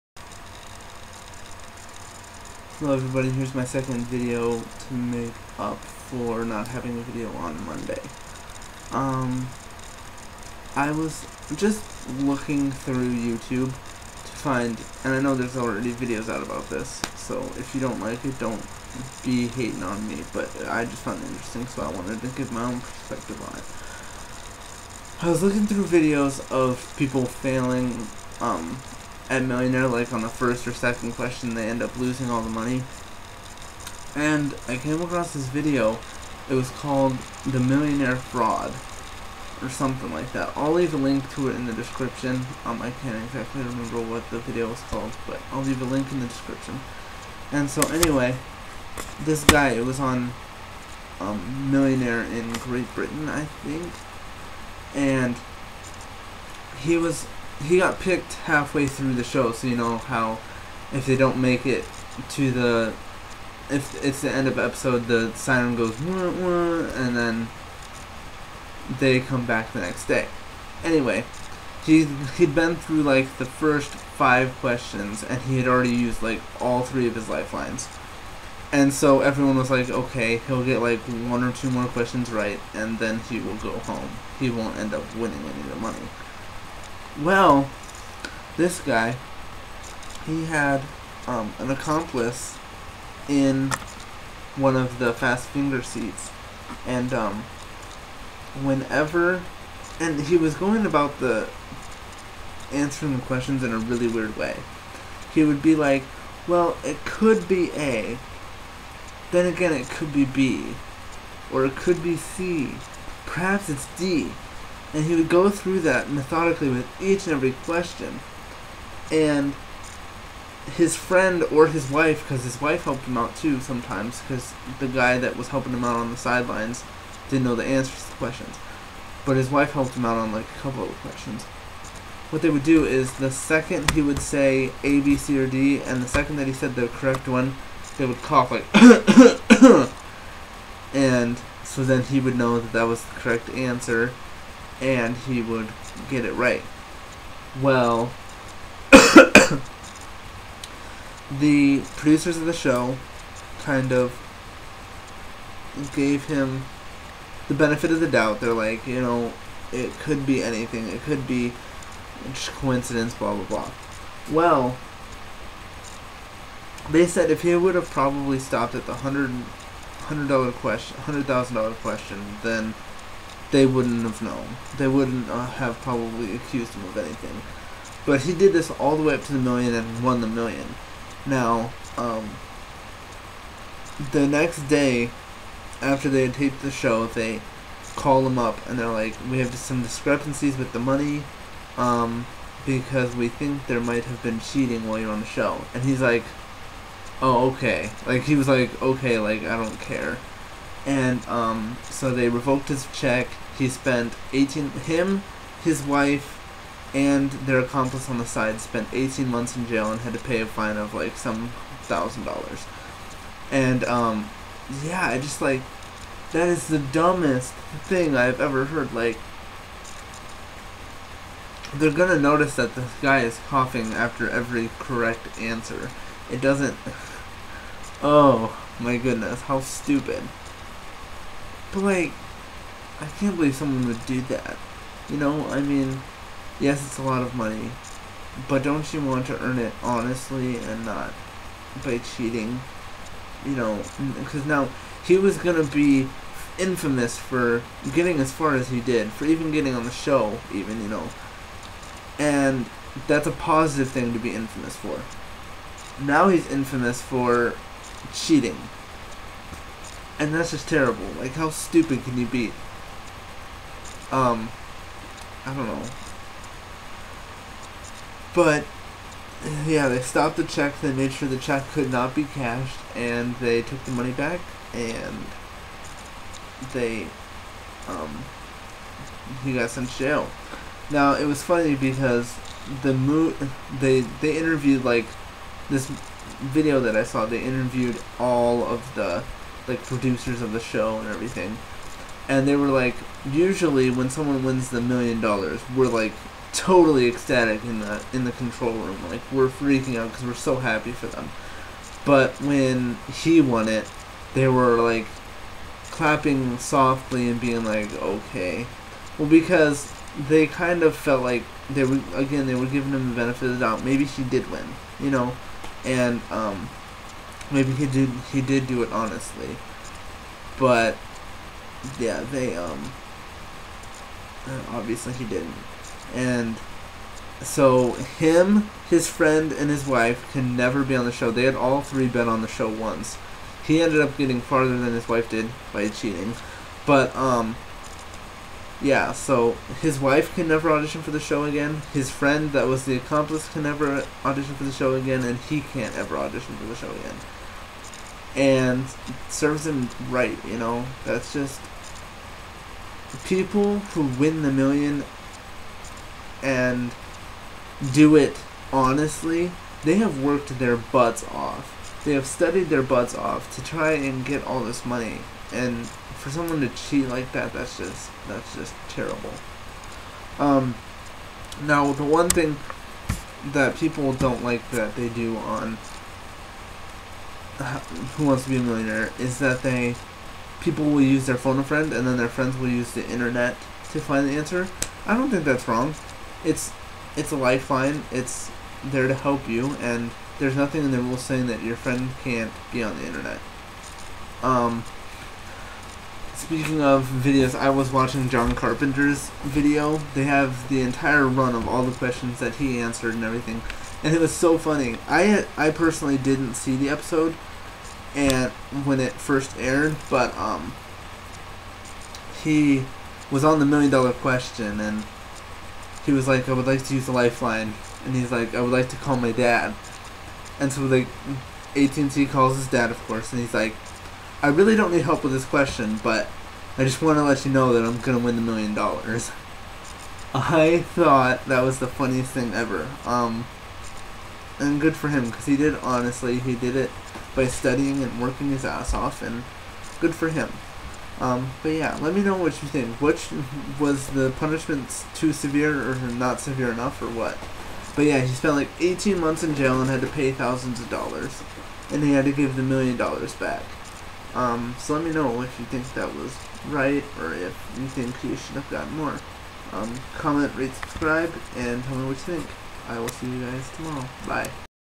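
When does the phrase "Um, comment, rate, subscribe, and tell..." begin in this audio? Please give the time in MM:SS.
07:39.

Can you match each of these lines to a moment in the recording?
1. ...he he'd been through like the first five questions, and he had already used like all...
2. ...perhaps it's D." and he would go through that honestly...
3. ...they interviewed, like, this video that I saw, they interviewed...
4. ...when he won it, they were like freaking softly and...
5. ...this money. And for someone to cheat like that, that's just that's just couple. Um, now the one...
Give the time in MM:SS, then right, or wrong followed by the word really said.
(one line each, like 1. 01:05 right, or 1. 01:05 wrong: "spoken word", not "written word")
1. 01:11 right
2. 01:53 wrong: "methodically", not "honestly"
3. 04:44 right
4. 05:02 wrong: "clapping", not "freaking"
5. 06:04 wrong: "terrible", not "couple".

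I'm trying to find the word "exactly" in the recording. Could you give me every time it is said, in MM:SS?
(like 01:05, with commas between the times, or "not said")
00:43.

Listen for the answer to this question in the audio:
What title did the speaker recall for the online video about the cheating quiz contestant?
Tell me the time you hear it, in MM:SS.
00:37.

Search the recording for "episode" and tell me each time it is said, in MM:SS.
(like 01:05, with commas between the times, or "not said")
01:04, 06:46.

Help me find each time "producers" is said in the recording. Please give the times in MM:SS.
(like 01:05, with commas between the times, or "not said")
02:31, 04:49.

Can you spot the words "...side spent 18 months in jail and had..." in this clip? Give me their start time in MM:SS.
03:28.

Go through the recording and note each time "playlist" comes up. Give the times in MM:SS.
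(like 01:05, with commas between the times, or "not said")
not said.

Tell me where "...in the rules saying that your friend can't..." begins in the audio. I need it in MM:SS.
06:30.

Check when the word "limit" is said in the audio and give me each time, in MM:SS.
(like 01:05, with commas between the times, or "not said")
not said.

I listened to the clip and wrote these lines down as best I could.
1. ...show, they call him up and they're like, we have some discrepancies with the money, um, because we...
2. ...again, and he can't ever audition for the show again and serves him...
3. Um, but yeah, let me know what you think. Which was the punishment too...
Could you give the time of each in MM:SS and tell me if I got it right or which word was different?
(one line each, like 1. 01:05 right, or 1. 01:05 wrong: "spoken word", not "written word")
1. 03:06 right
2. 05:44 right
3. 07:21 right.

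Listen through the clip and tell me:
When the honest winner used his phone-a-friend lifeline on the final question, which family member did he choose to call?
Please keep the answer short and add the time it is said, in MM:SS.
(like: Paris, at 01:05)
his dad, at 06:59.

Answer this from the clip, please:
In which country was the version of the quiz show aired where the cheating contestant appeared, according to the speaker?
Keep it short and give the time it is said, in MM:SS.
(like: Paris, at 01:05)
Great Britain, at 00:52.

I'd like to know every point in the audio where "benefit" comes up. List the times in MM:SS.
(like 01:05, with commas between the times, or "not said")
02:37, 05:13.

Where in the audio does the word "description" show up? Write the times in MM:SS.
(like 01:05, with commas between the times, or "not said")
00:41, 00:46.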